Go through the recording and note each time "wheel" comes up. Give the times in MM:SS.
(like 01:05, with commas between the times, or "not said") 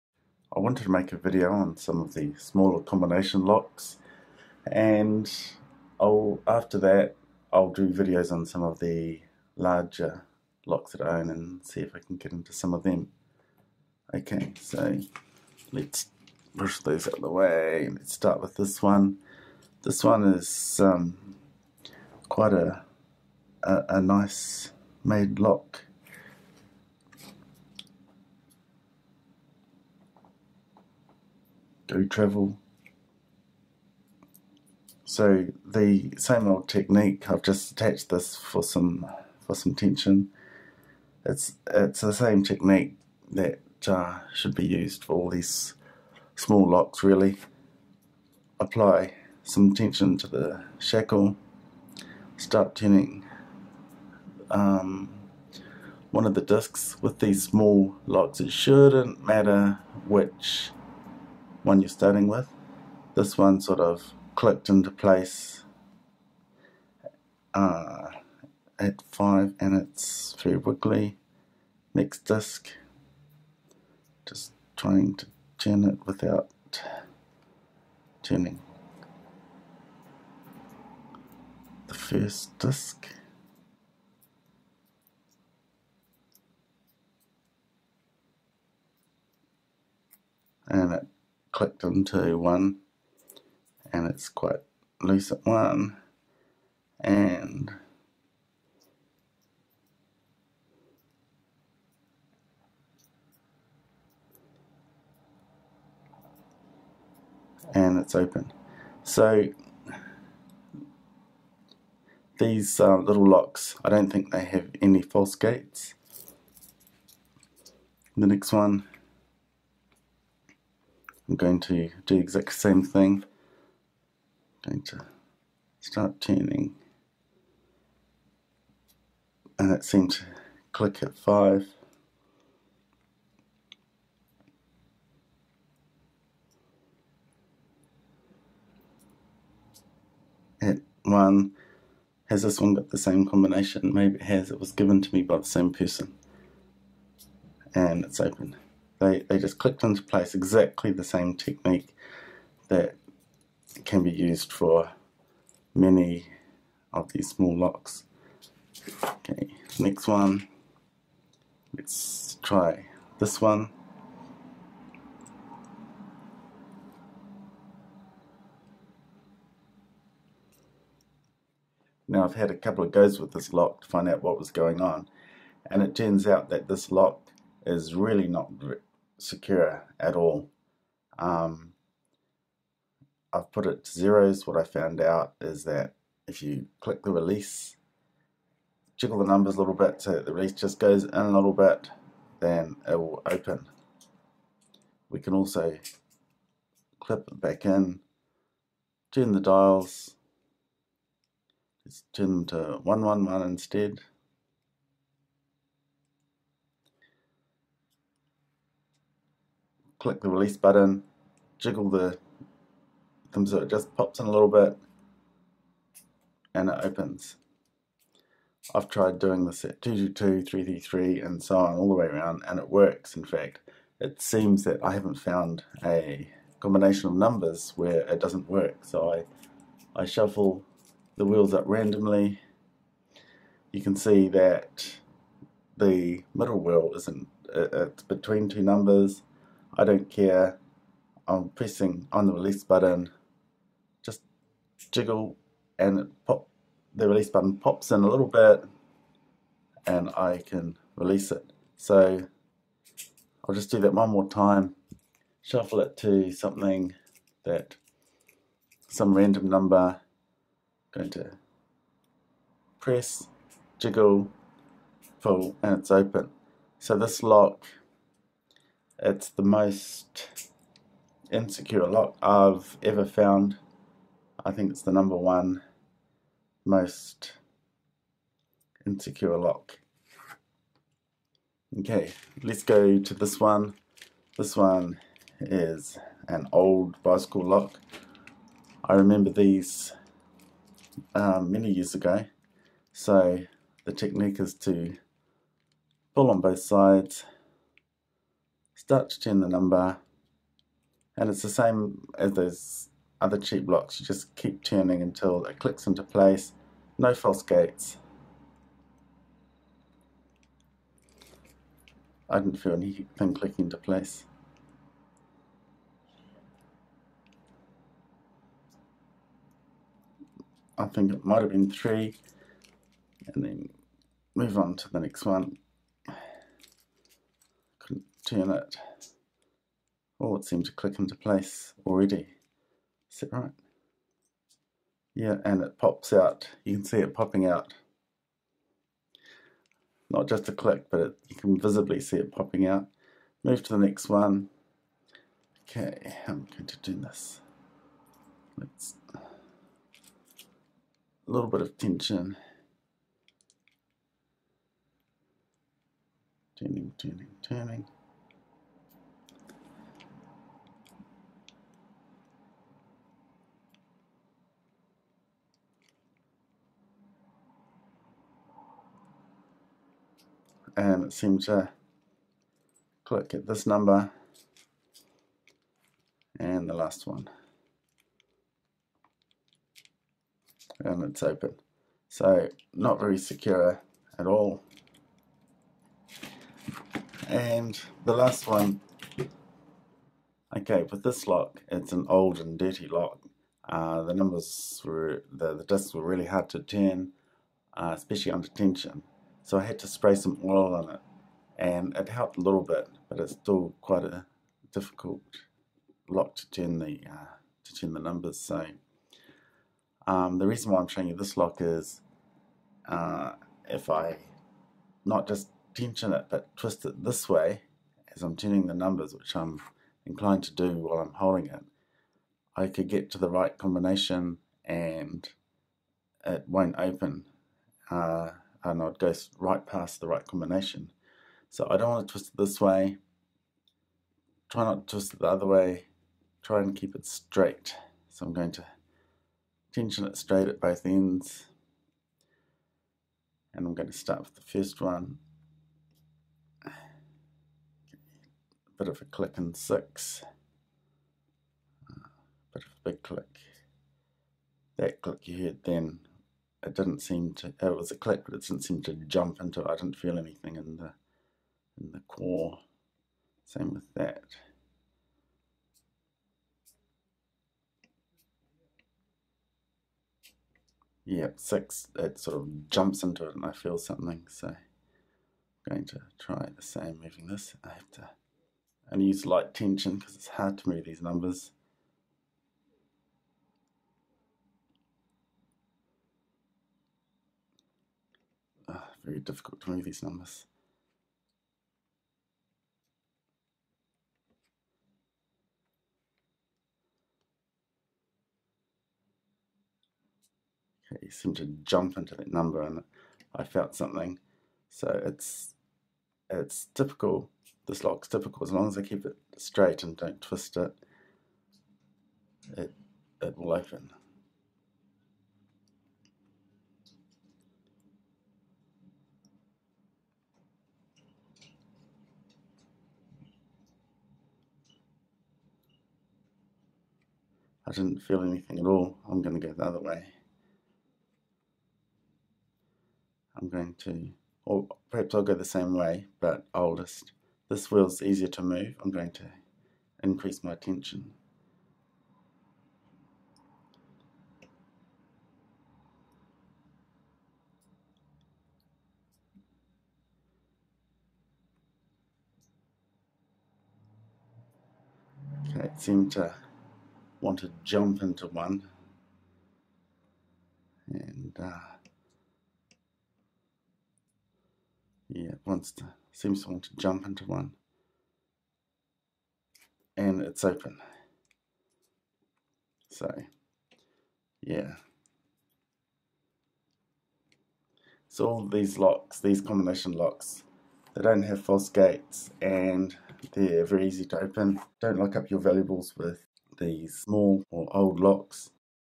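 03:51, 03:56, 08:57.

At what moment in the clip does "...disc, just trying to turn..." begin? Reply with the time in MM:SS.
01:12.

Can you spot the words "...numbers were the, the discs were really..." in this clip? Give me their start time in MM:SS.
06:34.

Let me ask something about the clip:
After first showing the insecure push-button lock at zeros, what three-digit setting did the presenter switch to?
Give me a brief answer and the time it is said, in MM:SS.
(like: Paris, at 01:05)
111, at 03:22.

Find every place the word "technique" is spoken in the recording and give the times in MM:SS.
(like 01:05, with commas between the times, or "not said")
00:36, 00:42, 02:31, 04:53.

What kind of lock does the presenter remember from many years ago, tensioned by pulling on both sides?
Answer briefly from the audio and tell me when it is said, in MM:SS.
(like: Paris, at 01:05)
bicycle lock, at 04:47.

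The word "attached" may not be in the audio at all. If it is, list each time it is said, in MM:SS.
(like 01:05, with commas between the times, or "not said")
00:37.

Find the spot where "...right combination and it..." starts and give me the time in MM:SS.
07:03.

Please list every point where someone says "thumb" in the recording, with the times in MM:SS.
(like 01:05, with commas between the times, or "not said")
03:33.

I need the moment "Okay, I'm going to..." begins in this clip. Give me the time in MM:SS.
05:45.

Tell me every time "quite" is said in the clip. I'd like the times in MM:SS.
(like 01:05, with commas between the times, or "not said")
00:22, 01:34, 06:43.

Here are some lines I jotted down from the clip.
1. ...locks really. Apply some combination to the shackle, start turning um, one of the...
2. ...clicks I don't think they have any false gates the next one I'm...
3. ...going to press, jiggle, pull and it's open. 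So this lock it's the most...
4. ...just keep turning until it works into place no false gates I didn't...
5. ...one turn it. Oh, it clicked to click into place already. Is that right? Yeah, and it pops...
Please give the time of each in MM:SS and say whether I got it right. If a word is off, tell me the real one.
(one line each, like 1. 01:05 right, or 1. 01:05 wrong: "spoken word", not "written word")
1. 00:46 wrong: "tension", not "combination"
2. 01:53 wrong: "locks", not "clicks"
3. 04:20 right
4. 05:04 wrong: "clicks", not "works"
5. 05:25 wrong: "seemed", not "clicked".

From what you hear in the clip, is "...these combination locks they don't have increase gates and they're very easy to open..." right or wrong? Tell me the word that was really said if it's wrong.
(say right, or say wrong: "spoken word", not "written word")
wrong: "false", not "increase".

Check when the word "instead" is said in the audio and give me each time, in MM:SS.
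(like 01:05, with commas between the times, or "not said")
03:23.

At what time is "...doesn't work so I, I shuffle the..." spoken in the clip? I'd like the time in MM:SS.
03:48.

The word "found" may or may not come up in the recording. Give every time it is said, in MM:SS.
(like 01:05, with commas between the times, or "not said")
03:04, 03:45, 04:33.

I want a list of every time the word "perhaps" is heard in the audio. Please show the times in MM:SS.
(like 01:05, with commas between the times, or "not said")
08:54.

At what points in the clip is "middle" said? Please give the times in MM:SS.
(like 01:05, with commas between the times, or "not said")
03:56.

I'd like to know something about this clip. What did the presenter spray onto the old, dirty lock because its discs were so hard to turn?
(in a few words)
oil.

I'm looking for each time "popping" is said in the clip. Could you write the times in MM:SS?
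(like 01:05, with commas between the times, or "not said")
05:37, 05:42.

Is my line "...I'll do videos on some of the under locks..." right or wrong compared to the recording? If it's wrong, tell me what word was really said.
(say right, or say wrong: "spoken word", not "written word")
wrong: "larger", not "under".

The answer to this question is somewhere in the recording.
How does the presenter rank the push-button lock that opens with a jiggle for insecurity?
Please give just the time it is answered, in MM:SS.
04:34.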